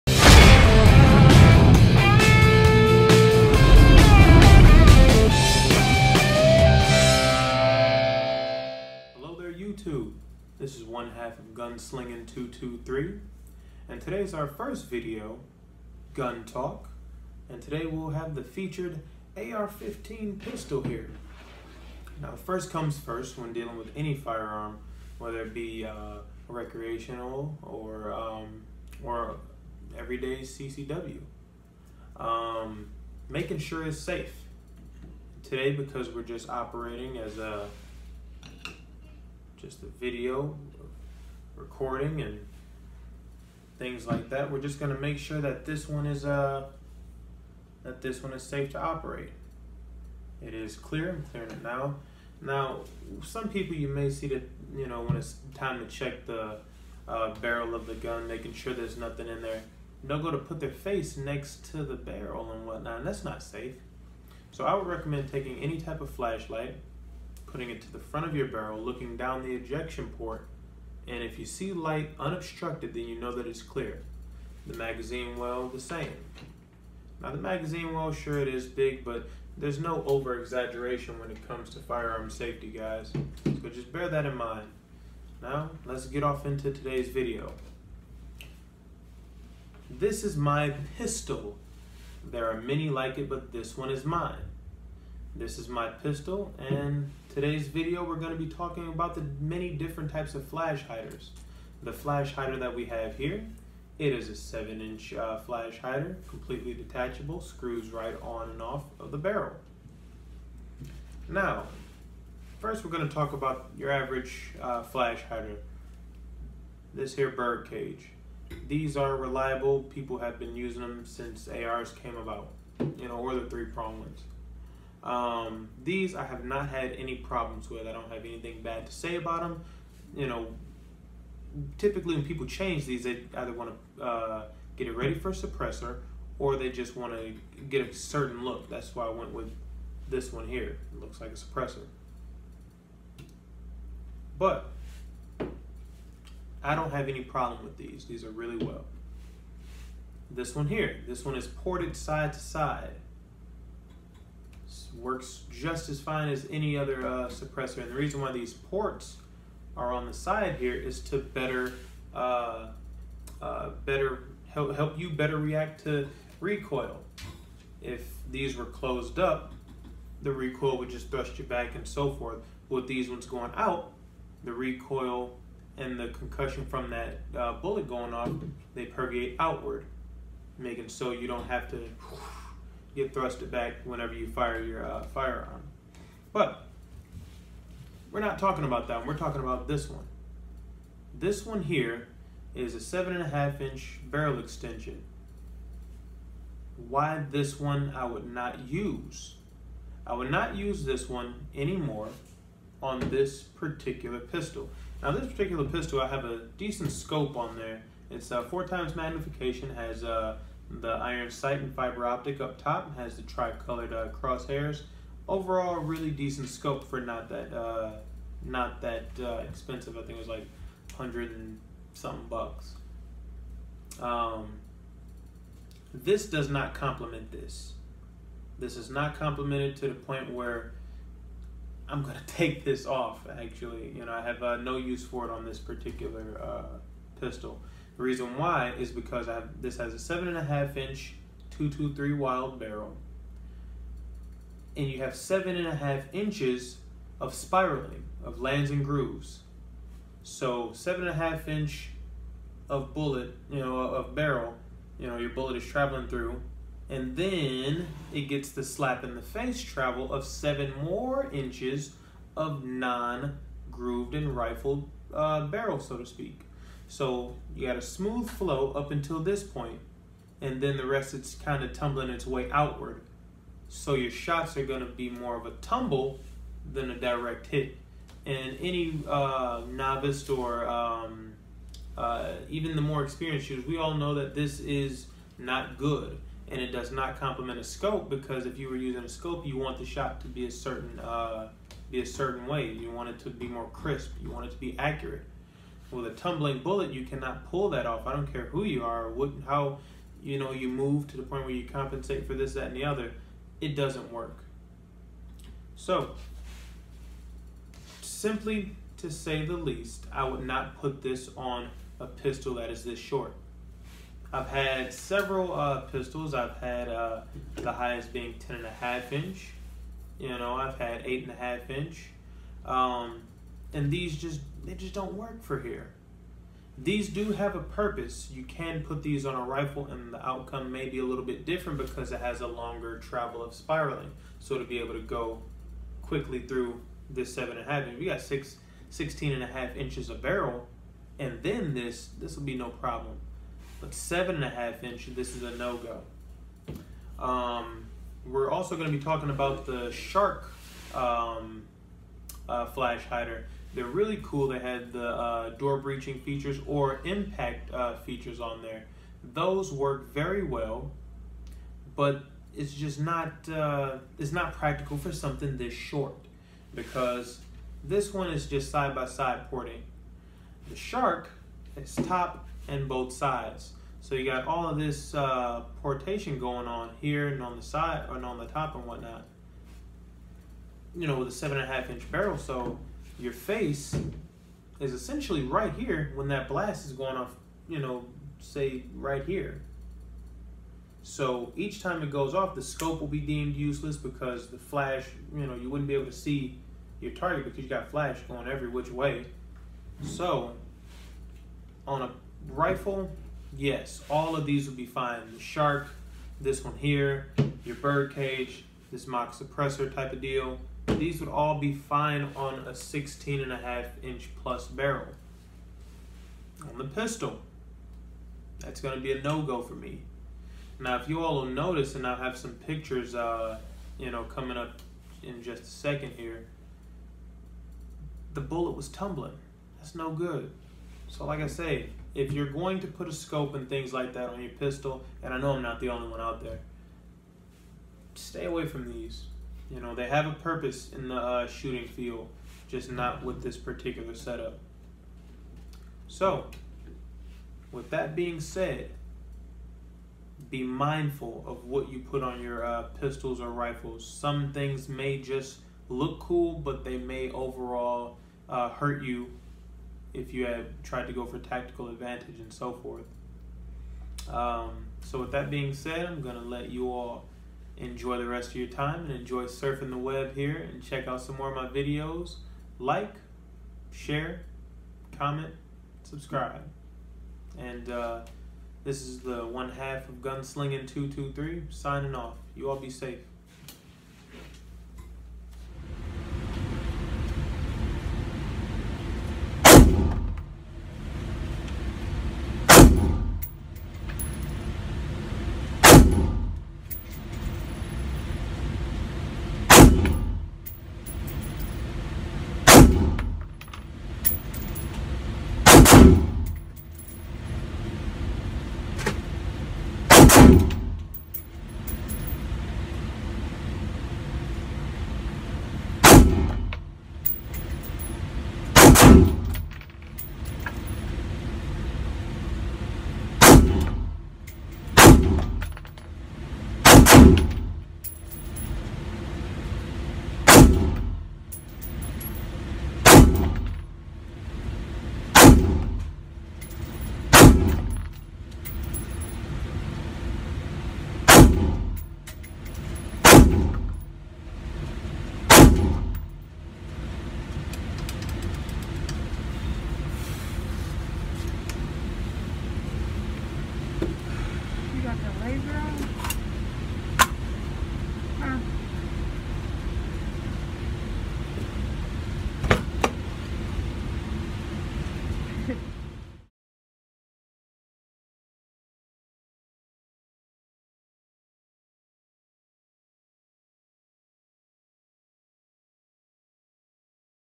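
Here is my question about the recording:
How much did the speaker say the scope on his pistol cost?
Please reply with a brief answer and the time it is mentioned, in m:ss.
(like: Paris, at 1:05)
hundred and something bucks, at 3:40.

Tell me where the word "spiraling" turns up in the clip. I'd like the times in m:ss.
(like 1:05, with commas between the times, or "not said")
4:07, 5:33.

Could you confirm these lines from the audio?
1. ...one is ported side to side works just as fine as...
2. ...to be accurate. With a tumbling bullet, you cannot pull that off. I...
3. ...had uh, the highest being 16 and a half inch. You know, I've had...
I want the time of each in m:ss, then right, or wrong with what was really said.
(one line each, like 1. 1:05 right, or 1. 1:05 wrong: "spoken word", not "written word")
1. 2:31 right
2. 4:54 right
3. 5:16 wrong: "10", not "16".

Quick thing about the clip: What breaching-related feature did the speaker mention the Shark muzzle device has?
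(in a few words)
door breaching.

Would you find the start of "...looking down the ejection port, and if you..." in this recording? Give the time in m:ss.
1:08.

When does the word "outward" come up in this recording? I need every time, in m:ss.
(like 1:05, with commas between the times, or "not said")
2:59, 4:32.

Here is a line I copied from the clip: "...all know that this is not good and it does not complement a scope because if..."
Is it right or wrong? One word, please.
right.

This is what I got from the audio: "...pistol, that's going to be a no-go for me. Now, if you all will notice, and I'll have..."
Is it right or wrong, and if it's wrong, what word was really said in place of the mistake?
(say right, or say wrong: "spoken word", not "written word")
right.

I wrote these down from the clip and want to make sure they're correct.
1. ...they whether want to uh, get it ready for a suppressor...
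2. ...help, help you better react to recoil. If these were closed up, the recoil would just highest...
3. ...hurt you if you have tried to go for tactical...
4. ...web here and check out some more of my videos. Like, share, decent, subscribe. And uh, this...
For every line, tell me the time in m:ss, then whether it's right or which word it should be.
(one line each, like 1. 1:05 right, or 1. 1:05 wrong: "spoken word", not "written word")
1. 2:13 wrong: "either", not "whether"
2. 2:44 wrong: "thrust", not "highest"
3. 7:38 right
4. 7:49 wrong: "comment", not "decent".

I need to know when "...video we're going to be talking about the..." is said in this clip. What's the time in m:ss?
1:37.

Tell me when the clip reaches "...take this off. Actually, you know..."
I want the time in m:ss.
3:52.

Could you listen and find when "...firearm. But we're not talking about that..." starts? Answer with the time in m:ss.
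3:05.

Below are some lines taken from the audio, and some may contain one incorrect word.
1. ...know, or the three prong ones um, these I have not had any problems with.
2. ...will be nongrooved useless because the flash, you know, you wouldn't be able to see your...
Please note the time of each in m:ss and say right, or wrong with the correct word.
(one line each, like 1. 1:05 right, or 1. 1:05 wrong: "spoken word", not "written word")
1. 2:03 right
2. 6:32 wrong: "deemed", not "nongrooved".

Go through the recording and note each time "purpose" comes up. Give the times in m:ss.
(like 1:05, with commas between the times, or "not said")
5:27, 7:20.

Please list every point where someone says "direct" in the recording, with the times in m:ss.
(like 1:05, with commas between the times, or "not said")
4:36.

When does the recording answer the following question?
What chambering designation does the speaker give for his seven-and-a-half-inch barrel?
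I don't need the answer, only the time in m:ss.
4:01.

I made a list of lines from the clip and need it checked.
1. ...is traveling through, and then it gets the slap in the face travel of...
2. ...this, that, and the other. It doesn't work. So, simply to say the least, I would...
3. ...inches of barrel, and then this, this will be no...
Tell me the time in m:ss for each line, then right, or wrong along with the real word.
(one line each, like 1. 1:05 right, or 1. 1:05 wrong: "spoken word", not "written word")
1. 4:15 right
2. 5:02 right
3. 5:39 right.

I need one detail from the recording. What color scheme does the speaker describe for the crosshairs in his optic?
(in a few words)
tri-colored.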